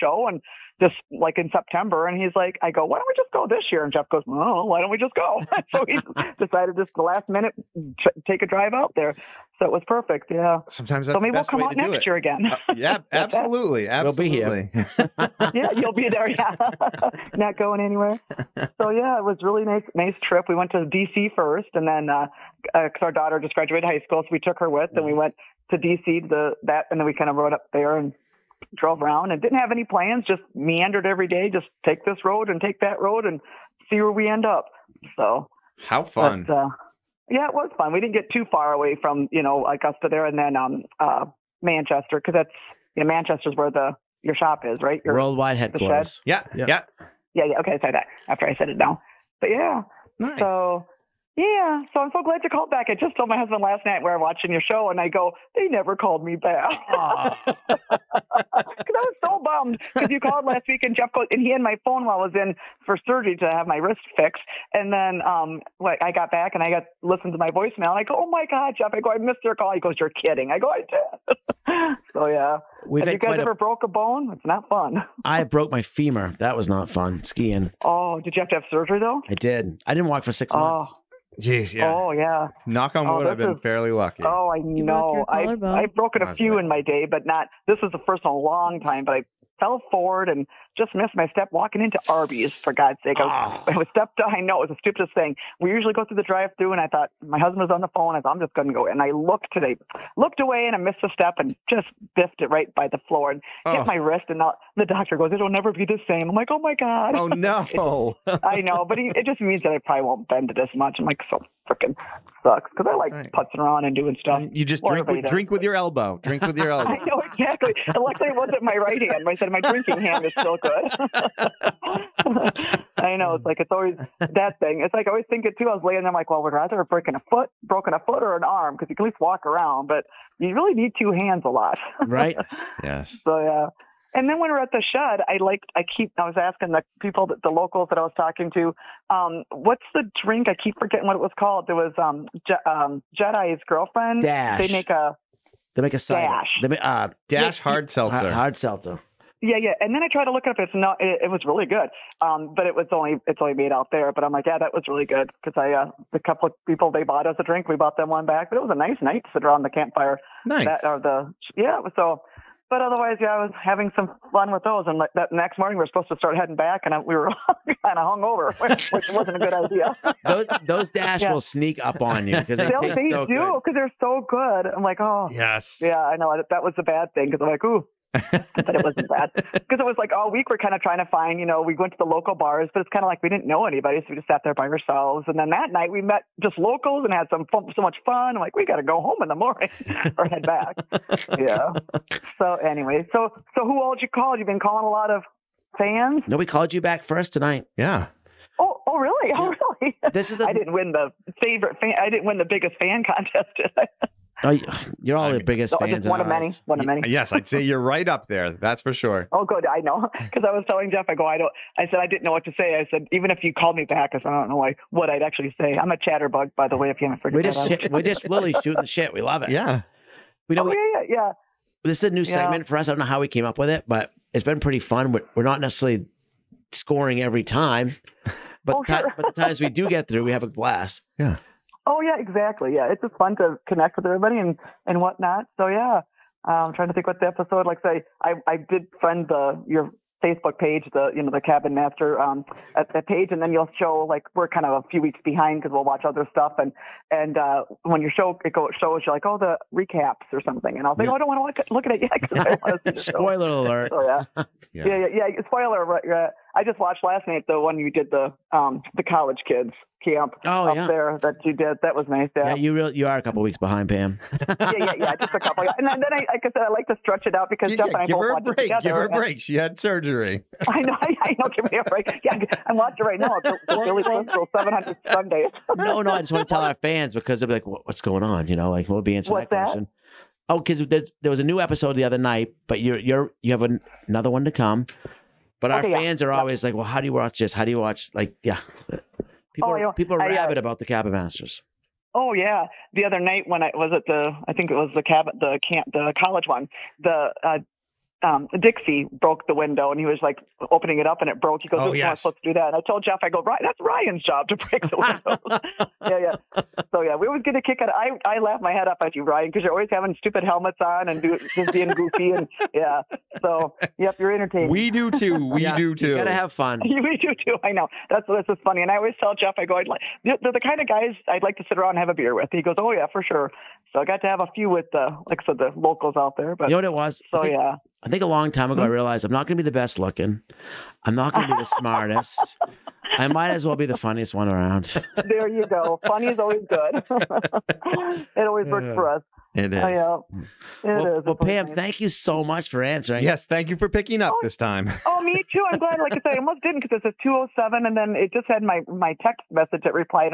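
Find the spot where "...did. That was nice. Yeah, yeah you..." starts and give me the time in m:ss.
4:21.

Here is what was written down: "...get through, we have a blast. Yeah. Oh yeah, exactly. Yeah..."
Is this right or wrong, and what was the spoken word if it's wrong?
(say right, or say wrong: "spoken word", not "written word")
right.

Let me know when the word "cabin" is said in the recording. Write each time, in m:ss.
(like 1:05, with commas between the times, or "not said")
4:01, 4:50, 4:55.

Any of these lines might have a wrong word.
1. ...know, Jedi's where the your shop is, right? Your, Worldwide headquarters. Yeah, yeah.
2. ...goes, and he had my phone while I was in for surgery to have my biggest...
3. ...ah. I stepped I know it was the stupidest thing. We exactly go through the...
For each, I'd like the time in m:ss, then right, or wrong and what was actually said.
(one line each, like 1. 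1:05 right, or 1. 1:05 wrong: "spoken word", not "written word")
1. 0:43 wrong: "Manchester", not "Jedi"
2. 1:01 wrong: "wrist", not "biggest"
3. 1:33 wrong: "usually", not "exactly".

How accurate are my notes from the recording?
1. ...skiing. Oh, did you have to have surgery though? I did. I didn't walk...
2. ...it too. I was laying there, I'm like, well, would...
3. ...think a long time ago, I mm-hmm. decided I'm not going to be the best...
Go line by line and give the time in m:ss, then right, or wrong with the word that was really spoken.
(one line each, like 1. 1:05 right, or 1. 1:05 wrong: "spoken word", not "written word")
1. 1:17 right
2. 2:05 right
3. 5:28 wrong: "realized", not "decided".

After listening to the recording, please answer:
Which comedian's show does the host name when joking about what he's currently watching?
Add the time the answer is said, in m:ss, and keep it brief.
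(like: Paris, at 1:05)
Billy Crystal, at 4:33.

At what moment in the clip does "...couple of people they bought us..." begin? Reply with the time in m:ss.
2:36.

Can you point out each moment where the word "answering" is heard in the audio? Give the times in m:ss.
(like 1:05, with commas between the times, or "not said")
4:39, 5:42.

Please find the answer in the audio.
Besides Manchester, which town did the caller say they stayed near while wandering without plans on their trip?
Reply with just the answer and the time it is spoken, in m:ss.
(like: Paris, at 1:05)
Augusta, at 0:39.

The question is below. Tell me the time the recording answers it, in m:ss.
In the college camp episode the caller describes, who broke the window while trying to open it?
4:58.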